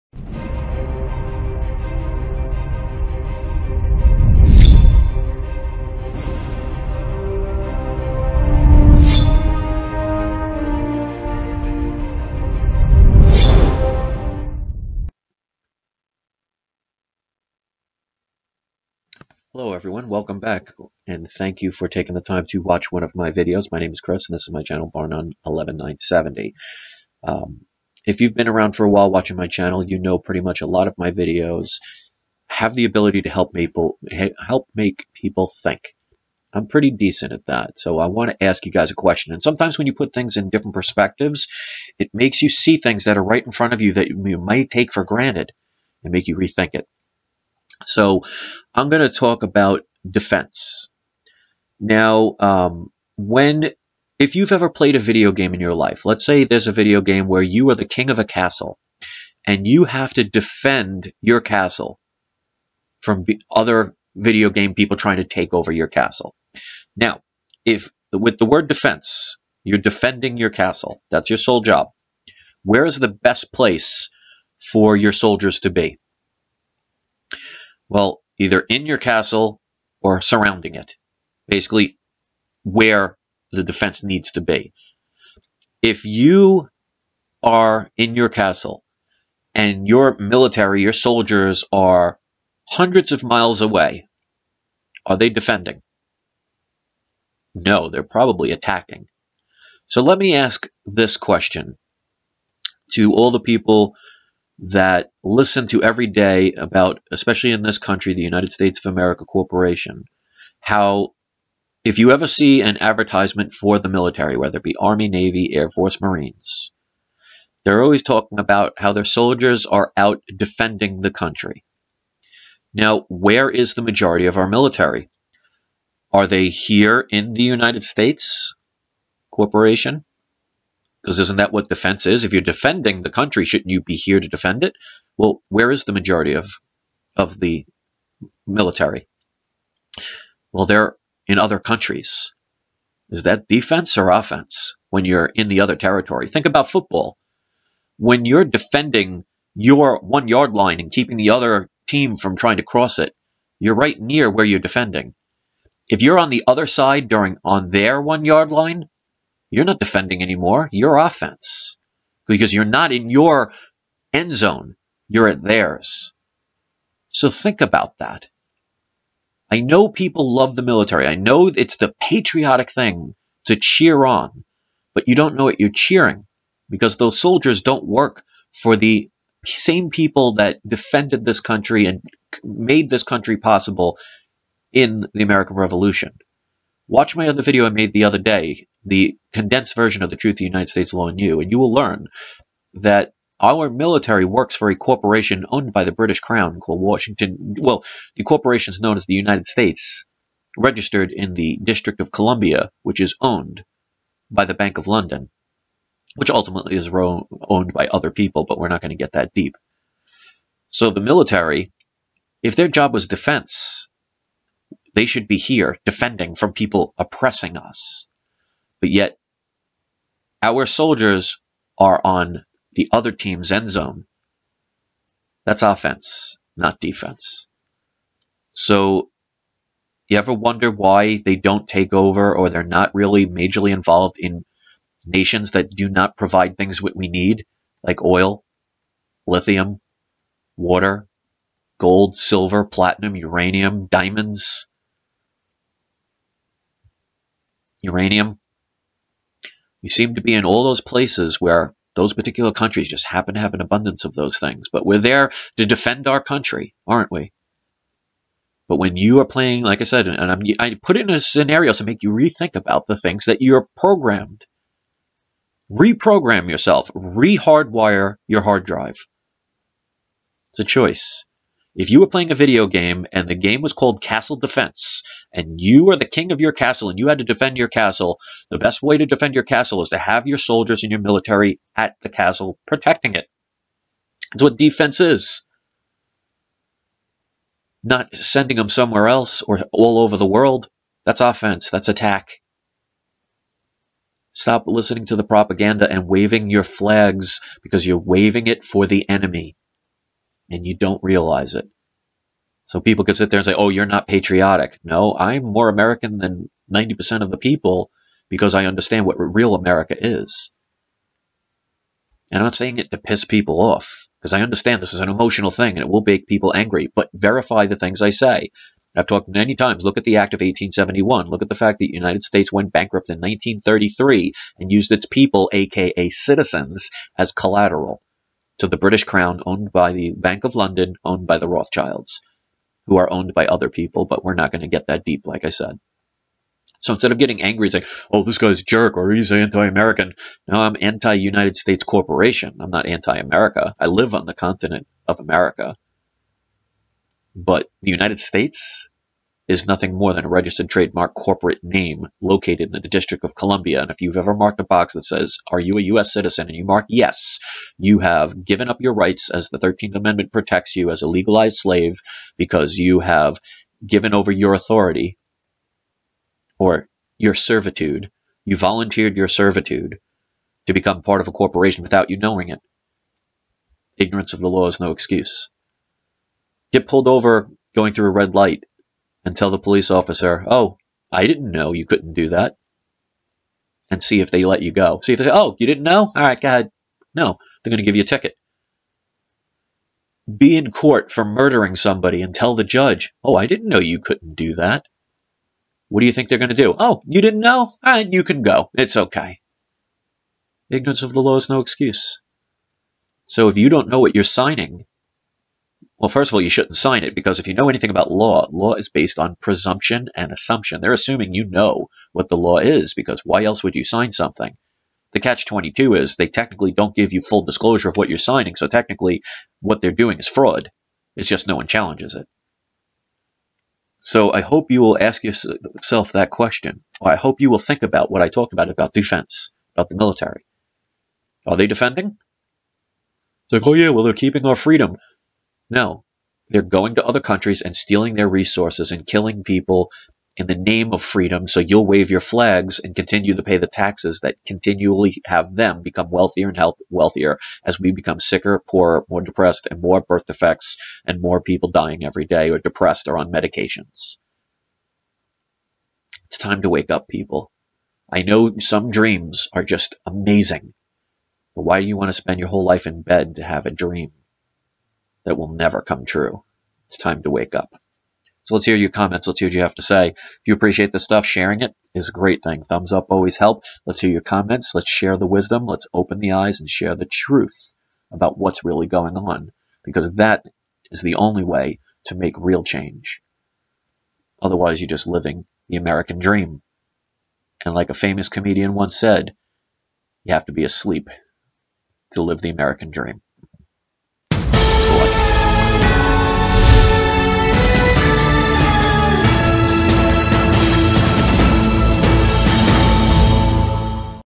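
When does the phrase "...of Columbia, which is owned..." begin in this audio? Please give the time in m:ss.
3:22.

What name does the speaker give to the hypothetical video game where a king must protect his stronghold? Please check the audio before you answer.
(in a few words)
Castle Defense.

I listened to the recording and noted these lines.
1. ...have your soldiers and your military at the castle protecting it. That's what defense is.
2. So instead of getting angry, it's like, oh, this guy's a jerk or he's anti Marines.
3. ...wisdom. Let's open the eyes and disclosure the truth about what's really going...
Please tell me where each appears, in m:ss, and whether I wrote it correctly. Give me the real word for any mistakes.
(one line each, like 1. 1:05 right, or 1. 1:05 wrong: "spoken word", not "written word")
1. 4:39 right
2. 5:36 wrong: "American", not "Marines"
3. 7:55 wrong: "share", not "disclosure".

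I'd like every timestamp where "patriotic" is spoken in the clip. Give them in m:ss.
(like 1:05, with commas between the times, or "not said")
2:52, 5:04.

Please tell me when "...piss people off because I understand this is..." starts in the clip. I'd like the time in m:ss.
5:12.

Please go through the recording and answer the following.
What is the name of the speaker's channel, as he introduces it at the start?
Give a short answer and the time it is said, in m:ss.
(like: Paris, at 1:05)
Barnone 11970, at 0:24.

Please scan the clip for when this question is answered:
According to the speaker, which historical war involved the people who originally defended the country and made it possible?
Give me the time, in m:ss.
3:05.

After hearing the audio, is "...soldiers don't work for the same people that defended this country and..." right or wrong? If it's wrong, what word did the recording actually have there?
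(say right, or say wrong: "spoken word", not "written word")
right.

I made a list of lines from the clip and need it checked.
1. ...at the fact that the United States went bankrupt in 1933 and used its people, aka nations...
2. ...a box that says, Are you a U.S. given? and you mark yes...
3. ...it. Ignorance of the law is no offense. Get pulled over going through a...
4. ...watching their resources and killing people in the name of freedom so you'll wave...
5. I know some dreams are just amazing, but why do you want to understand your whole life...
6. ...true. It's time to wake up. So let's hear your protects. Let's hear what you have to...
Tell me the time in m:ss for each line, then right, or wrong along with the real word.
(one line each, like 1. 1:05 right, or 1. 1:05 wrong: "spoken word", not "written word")
1. 5:21 wrong: "citizens", not "nations"
2. 5:54 wrong: "citizen", not "given"
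3. 6:12 wrong: "excuse", not "offense"
4. 7:17 wrong: "stealing", not "watching"
5. 7:38 wrong: "spend", not "understand"
6. 7:46 wrong: "comments", not "protects".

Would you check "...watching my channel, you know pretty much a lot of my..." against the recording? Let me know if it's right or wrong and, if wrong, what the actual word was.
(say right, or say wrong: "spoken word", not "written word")
right.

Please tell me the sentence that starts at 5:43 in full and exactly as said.
I live on the continent of America.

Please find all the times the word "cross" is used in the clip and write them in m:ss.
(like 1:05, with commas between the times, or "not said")
2:32.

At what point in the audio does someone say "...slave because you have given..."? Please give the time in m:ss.
6:01.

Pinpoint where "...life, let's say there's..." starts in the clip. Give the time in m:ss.
0:55.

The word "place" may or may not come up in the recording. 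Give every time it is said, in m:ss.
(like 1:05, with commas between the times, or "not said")
1:13, 4:10.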